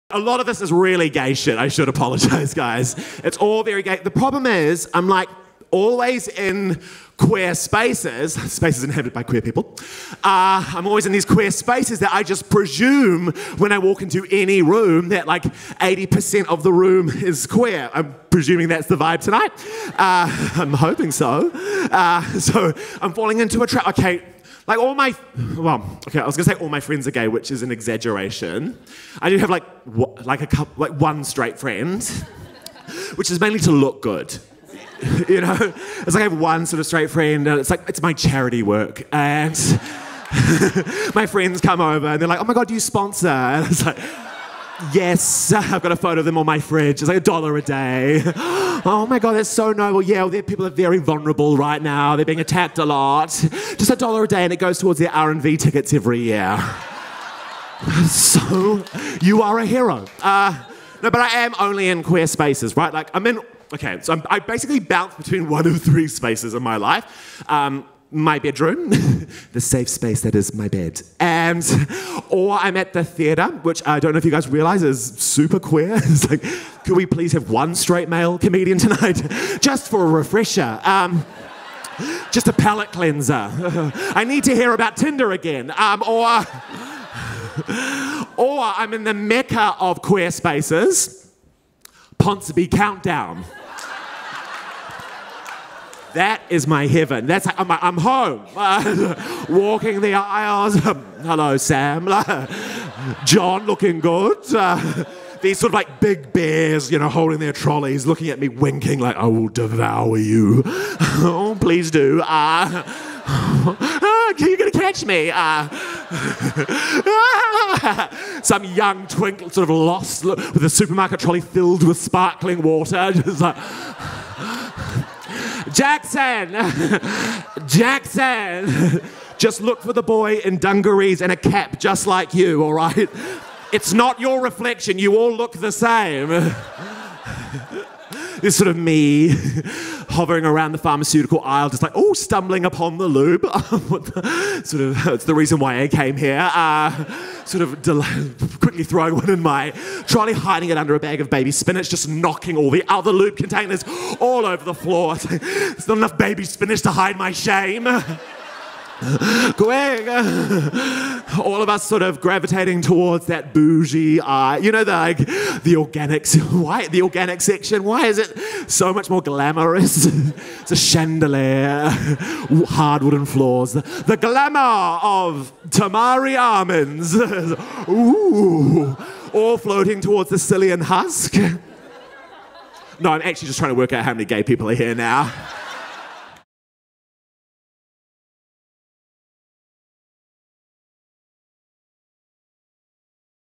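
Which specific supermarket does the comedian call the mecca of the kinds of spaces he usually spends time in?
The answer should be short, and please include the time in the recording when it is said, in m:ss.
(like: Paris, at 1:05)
Ponsonby Countdown, at 1:32.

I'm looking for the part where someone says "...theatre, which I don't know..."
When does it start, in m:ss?
1:13.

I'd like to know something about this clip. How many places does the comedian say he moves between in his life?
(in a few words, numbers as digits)
3.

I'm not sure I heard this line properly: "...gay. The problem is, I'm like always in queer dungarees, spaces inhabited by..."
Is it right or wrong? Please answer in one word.
wrong.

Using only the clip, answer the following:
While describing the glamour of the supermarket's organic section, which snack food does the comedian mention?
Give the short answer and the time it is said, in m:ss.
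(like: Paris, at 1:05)
Tamari almonds, at 2:55.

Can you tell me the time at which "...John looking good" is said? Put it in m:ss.
1:43.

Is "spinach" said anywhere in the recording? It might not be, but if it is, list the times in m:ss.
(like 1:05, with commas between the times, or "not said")
2:31, 2:36.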